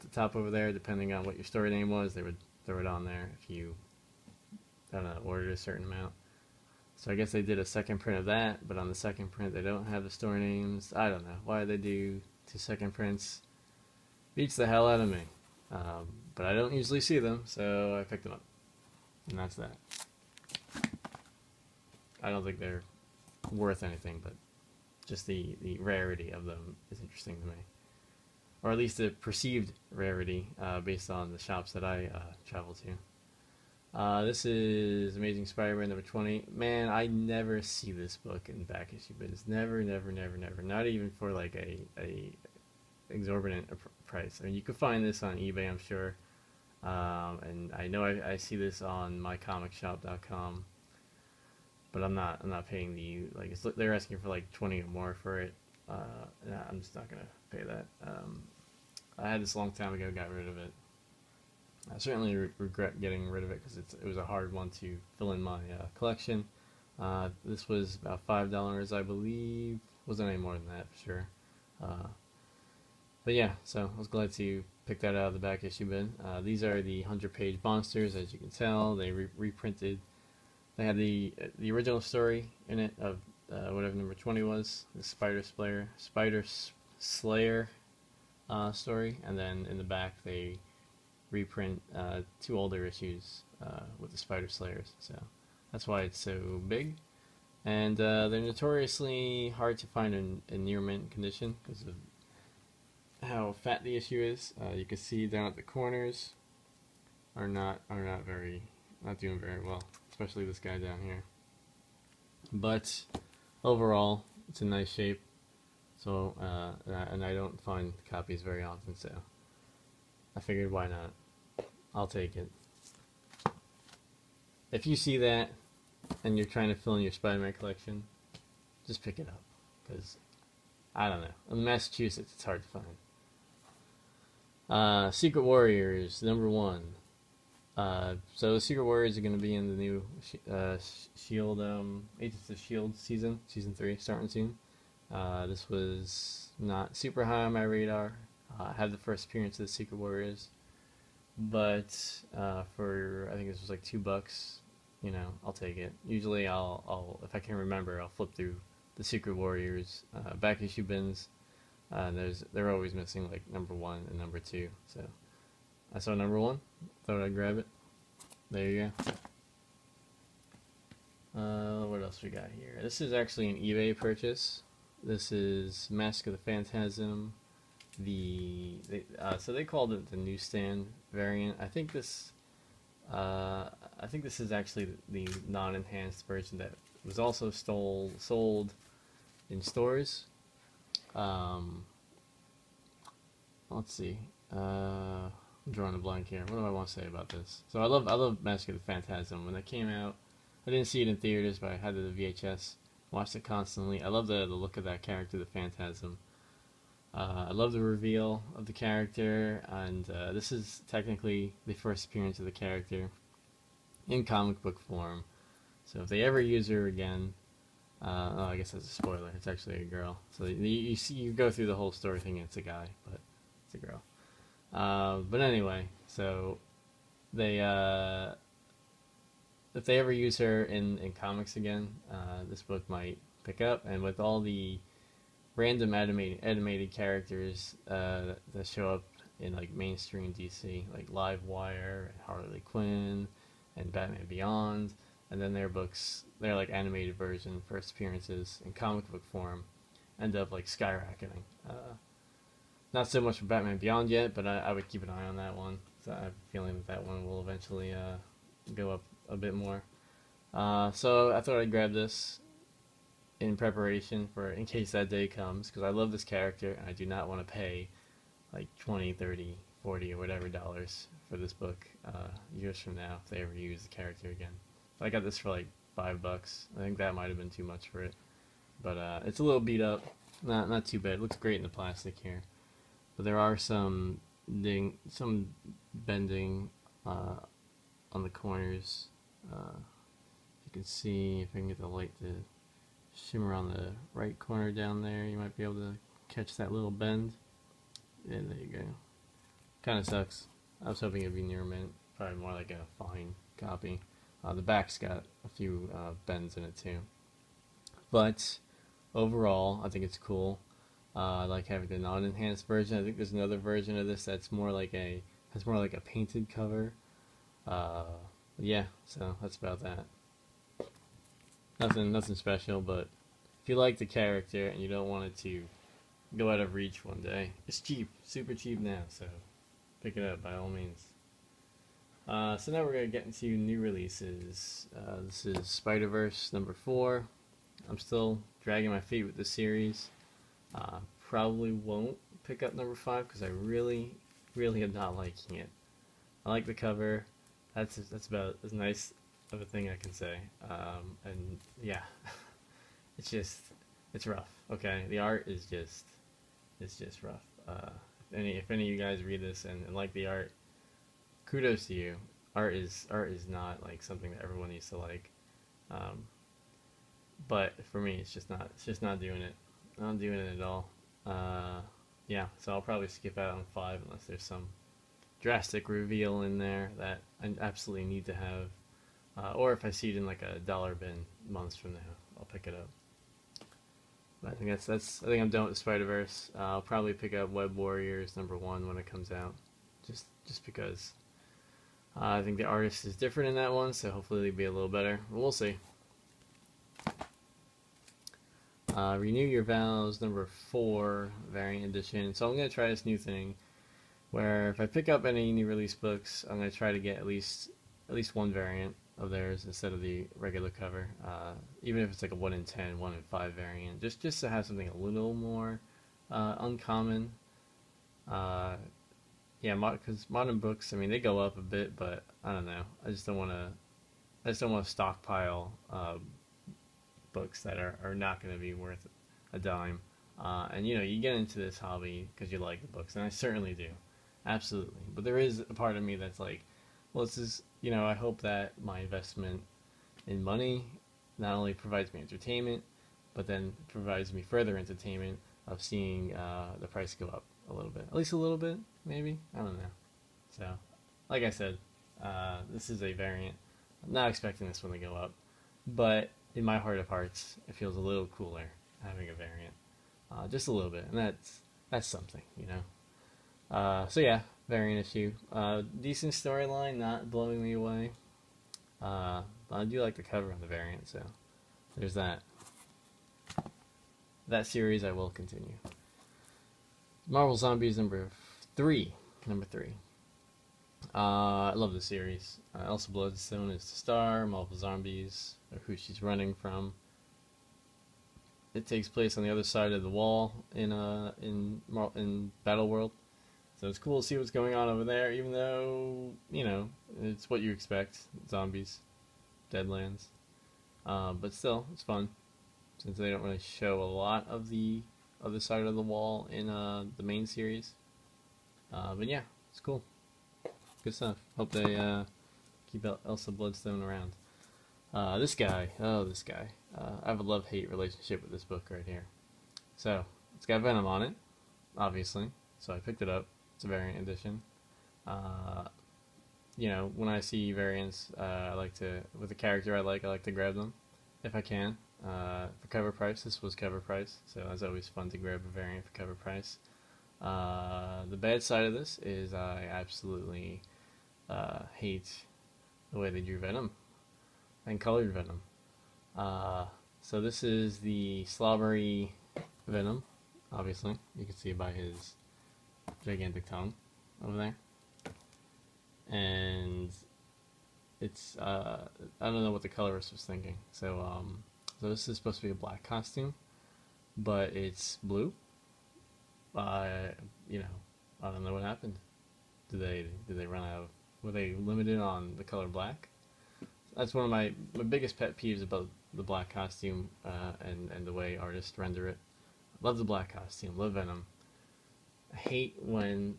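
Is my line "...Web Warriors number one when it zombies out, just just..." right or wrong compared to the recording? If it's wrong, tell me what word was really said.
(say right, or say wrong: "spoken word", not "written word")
wrong: "comes", not "zombies".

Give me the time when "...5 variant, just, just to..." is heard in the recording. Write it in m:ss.
6:53.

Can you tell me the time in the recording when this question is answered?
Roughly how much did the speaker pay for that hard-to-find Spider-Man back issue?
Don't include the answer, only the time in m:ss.
1:07.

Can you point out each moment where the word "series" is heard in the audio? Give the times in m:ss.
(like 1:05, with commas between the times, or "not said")
5:39, 7:54, 8:02, 8:27.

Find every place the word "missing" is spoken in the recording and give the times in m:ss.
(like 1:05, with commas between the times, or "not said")
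2:42.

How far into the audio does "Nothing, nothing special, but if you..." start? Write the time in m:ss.
5:21.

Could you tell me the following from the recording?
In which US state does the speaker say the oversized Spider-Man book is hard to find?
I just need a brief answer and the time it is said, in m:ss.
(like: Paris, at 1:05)
Massachusetts, at 2:11.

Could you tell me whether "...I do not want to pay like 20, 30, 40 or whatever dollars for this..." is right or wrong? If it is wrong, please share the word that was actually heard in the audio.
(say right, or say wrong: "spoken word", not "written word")
right.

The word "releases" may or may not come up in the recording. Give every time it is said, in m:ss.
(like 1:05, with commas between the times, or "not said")
5:33, 6:45.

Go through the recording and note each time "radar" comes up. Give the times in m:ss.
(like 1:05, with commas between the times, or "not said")
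2:27.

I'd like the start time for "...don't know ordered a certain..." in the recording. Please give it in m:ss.
0:04.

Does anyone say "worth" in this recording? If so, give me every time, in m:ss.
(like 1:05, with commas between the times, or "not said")
0:23, 7:08.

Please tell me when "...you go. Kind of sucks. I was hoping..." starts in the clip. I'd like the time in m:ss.
4:58.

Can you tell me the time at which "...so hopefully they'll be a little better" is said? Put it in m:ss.
6:33.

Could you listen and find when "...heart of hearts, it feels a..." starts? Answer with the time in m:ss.
7:36.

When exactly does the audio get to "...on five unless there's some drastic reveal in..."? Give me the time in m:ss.
6:13.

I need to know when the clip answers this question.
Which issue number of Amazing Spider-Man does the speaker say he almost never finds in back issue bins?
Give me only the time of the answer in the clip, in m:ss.
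0:35.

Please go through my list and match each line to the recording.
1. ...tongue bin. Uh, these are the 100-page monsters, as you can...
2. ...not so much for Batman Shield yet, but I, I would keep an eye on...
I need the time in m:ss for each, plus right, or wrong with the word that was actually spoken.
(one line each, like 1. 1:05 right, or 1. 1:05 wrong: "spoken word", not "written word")
1. 1:15 wrong: "issue", not "tongue"
2. 4:12 wrong: "Beyond", not "Shield".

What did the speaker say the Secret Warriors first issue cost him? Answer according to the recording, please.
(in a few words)
$2.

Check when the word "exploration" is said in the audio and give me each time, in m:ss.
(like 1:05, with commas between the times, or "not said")
not said.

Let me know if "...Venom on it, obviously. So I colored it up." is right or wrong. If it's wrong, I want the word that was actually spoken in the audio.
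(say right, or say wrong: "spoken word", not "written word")
wrong: "picked", not "colored".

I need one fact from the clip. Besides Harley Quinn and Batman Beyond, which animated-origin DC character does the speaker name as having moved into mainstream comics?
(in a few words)
Livewire.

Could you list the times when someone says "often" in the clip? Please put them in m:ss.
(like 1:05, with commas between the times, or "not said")
1:58.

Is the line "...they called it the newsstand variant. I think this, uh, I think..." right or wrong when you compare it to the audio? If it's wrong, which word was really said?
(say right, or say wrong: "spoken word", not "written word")
right.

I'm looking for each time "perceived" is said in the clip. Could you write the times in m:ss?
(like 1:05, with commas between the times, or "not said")
0:29.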